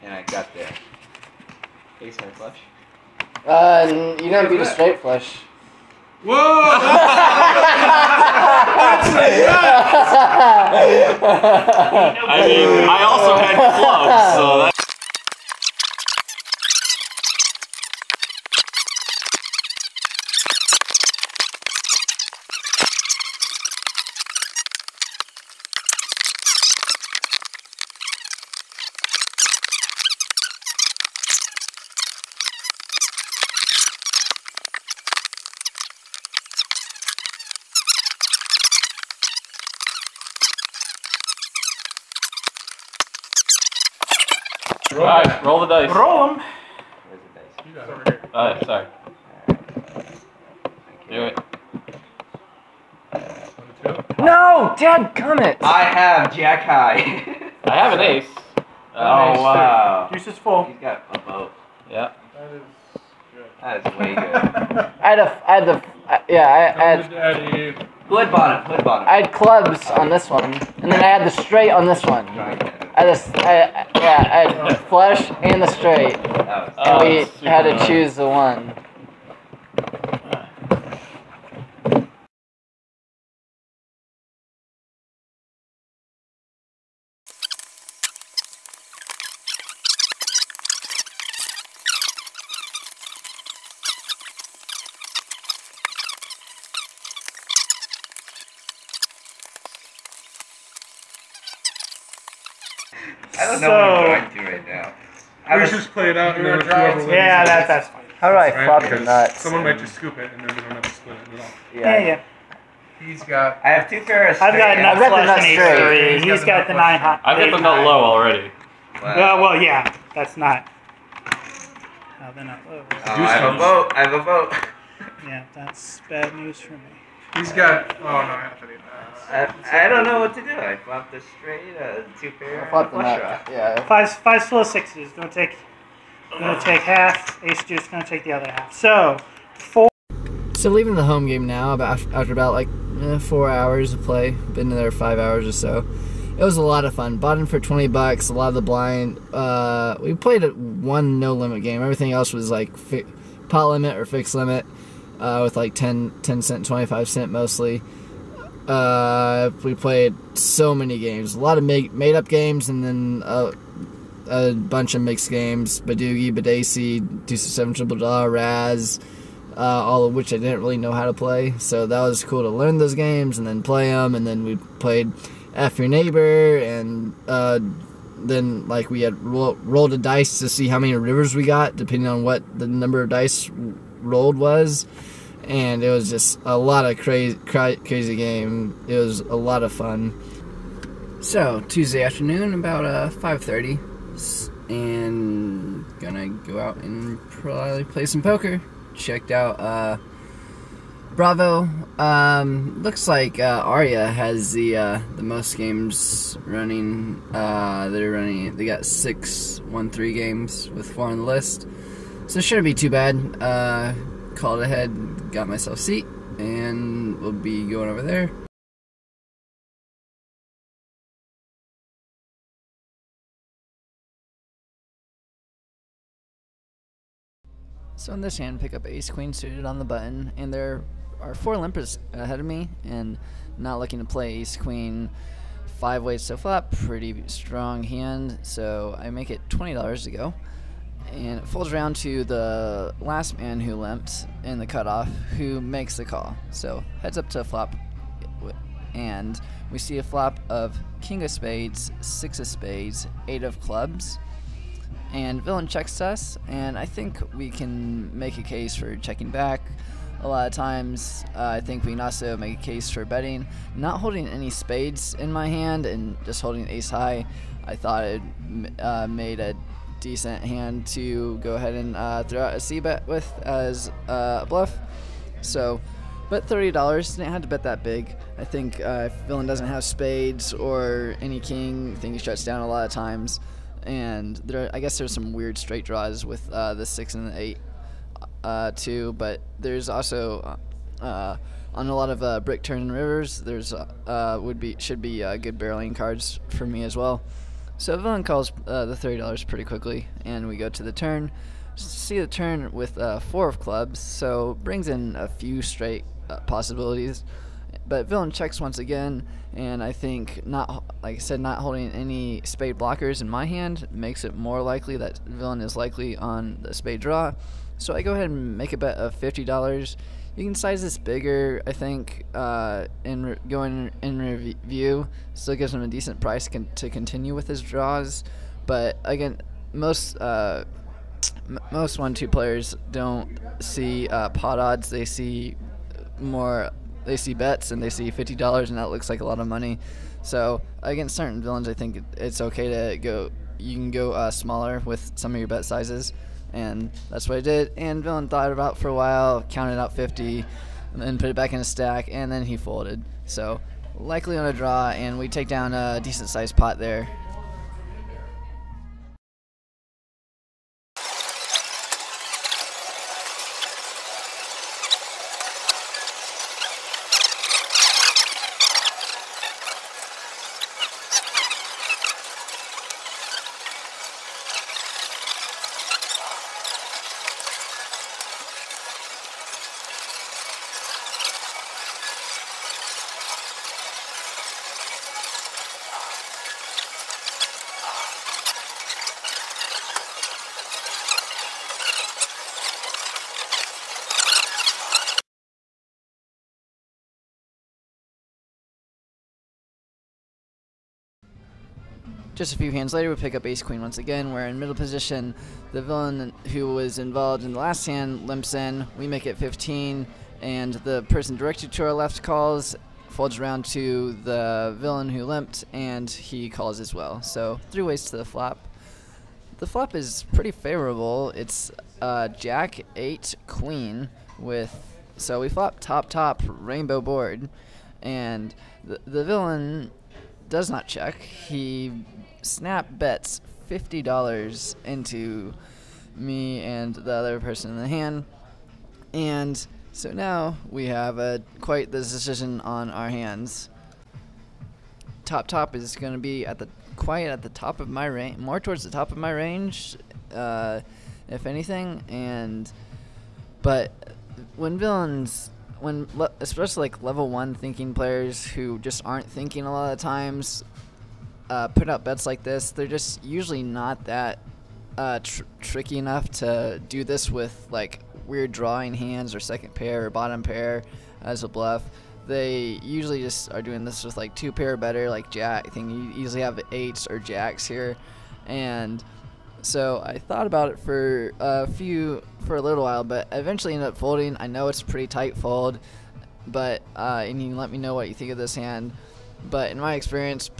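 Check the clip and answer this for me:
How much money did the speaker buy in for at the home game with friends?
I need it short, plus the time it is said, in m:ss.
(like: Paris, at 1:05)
$20, at 2:27.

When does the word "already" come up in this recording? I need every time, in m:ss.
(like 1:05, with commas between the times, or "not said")
1:58.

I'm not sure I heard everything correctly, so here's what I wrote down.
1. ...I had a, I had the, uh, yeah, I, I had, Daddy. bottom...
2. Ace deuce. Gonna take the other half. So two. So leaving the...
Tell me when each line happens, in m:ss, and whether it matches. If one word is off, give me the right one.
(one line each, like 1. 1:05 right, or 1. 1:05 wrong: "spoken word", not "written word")
1. 1:05 right
2. 2:17 wrong: "four", not "two".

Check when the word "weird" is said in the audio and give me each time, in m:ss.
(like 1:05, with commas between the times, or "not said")
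4:45, 7:48.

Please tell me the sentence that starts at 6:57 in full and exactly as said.
So three ways to the flop.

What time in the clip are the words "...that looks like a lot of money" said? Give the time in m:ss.
5:38.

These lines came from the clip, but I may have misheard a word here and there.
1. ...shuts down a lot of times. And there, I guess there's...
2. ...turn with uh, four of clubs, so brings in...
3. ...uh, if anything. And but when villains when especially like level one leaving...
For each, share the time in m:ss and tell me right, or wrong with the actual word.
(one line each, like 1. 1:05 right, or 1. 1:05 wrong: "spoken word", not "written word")
1. 4:42 right
2. 5:02 right
3. 7:30 wrong: "thinking", not "leaving".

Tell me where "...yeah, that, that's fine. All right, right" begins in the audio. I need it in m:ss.
1:47.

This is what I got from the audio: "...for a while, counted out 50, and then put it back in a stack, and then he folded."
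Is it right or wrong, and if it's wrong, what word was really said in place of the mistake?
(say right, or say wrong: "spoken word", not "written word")
right.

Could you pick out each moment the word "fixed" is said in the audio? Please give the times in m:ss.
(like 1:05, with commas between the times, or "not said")
2:34.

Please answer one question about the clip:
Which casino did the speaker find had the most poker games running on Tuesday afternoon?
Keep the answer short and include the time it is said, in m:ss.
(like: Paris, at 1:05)
Aria, at 3:23.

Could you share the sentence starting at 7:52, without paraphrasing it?
They usually just are doing this with like two pair better, like jack thing.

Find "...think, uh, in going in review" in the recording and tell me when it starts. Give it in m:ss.
5:21.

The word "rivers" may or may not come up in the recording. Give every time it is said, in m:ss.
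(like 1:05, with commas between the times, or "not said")
3:00, 4:52.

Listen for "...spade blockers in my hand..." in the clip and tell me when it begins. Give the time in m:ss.
5:12.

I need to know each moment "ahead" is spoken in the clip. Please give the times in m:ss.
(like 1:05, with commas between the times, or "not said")
3:34, 3:52, 4:31, 5:18.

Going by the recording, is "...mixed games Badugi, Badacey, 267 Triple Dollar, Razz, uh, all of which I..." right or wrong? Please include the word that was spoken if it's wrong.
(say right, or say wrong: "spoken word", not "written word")
right.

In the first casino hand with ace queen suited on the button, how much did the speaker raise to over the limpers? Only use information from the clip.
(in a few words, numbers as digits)
$20.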